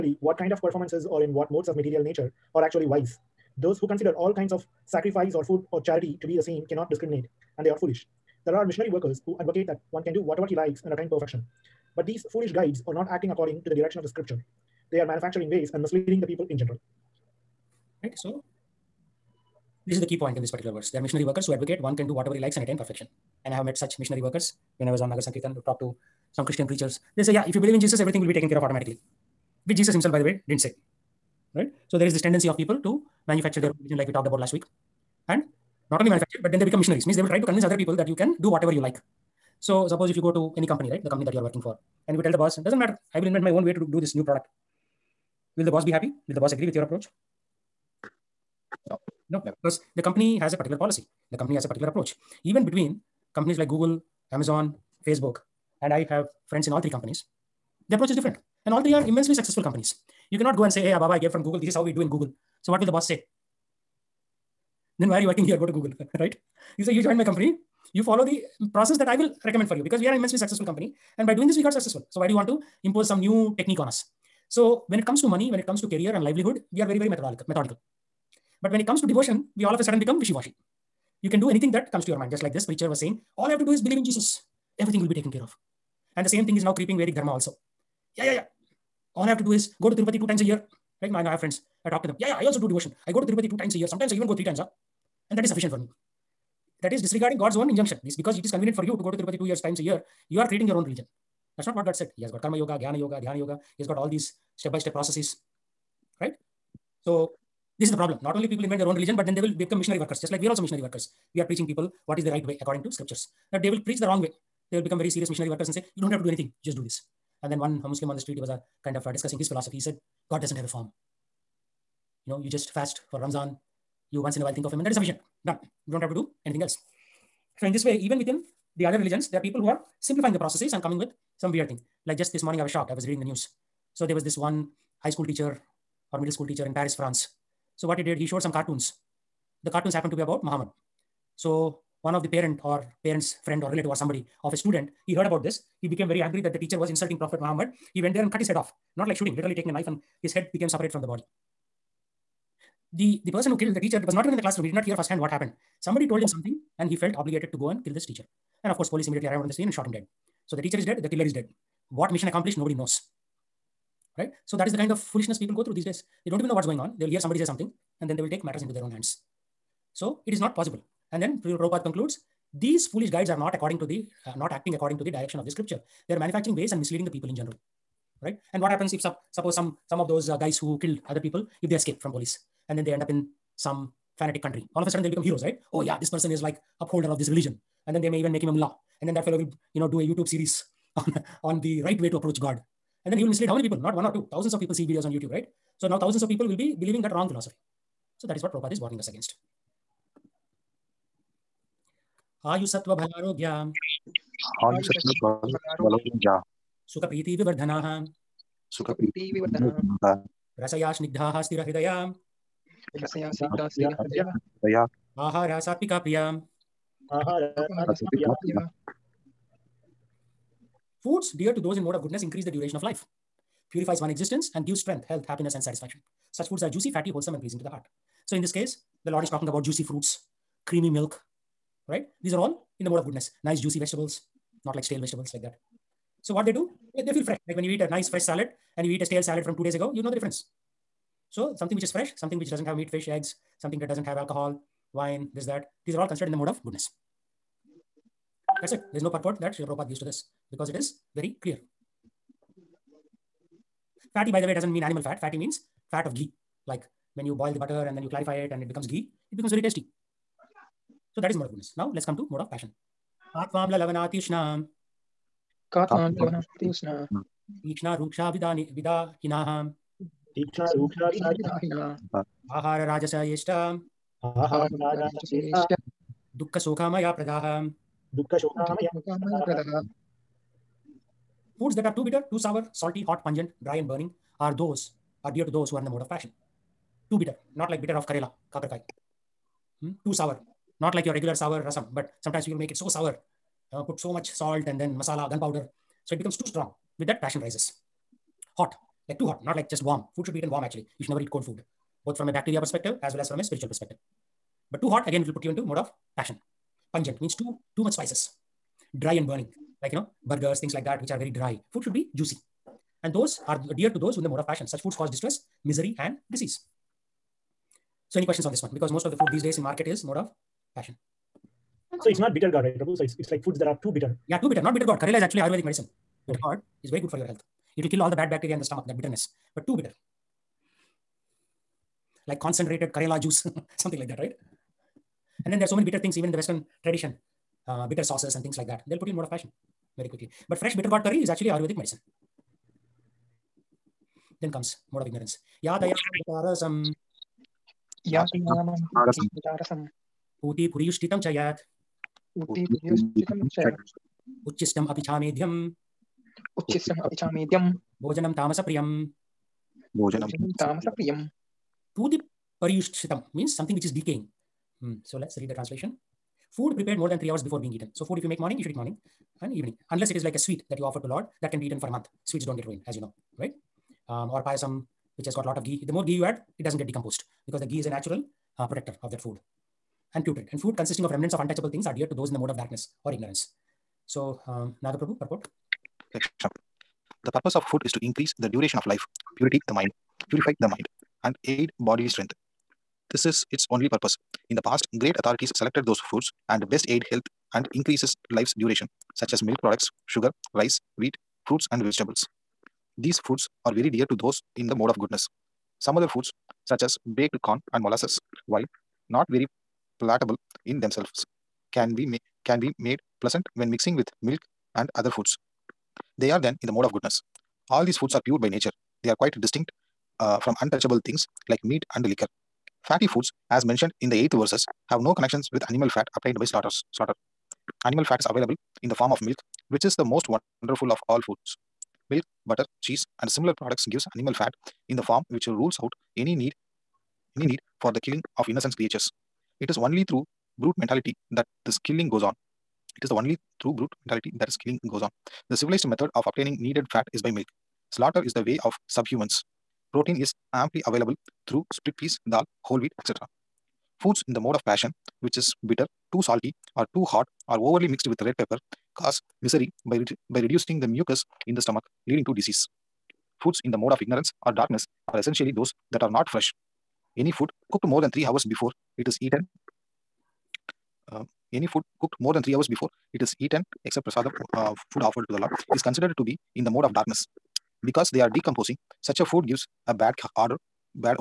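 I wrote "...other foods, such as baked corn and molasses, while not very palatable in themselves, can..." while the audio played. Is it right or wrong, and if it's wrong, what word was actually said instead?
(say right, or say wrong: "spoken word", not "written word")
right.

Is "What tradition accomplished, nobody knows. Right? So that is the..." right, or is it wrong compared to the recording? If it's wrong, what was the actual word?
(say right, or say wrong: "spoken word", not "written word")
wrong: "mission", not "tradition".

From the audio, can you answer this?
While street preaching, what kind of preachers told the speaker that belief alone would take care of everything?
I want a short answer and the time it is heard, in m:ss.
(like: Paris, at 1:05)
Christian preachers, at 0:26.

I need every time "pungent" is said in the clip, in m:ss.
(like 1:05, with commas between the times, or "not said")
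4:43, 5:06.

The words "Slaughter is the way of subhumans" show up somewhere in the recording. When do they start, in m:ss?
7:27.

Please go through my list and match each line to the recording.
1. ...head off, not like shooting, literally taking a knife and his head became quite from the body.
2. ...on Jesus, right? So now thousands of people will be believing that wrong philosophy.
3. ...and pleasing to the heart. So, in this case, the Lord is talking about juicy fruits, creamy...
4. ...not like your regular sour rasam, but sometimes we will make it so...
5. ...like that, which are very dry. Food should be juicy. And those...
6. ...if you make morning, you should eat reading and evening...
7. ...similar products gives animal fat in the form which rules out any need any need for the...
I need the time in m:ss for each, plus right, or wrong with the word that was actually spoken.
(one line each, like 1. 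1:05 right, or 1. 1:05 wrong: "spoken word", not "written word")
1. 2:28 wrong: "separate", not "quite"
2. 3:15 wrong: "YouTube", not "Jesus"
3. 3:47 right
4. 4:50 right
5. 5:10 right
6. 6:08 wrong: "morning", not "reading"
7. 7:13 right.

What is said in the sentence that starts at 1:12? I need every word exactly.
So why do you want to impose some new technique on us?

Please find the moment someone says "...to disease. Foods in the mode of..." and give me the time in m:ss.
7:42.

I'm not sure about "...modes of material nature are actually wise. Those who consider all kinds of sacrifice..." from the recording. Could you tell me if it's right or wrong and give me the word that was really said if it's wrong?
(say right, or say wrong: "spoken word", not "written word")
right.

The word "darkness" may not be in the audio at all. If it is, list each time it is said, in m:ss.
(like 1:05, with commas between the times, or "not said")
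6:22, 7:44, 7:56.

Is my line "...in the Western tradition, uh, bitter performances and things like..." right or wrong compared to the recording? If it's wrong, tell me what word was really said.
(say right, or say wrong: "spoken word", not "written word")
wrong: "sauces", not "performances".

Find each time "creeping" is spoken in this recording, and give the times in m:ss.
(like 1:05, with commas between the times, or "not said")
1:26.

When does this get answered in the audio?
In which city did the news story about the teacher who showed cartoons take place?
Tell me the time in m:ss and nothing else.
2:16.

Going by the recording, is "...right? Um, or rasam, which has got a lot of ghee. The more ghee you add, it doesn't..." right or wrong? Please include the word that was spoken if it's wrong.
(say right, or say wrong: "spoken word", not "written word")
wrong: "payasam", not "rasam".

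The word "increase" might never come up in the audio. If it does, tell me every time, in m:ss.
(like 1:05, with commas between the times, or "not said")
3:42, 6:28, 6:37.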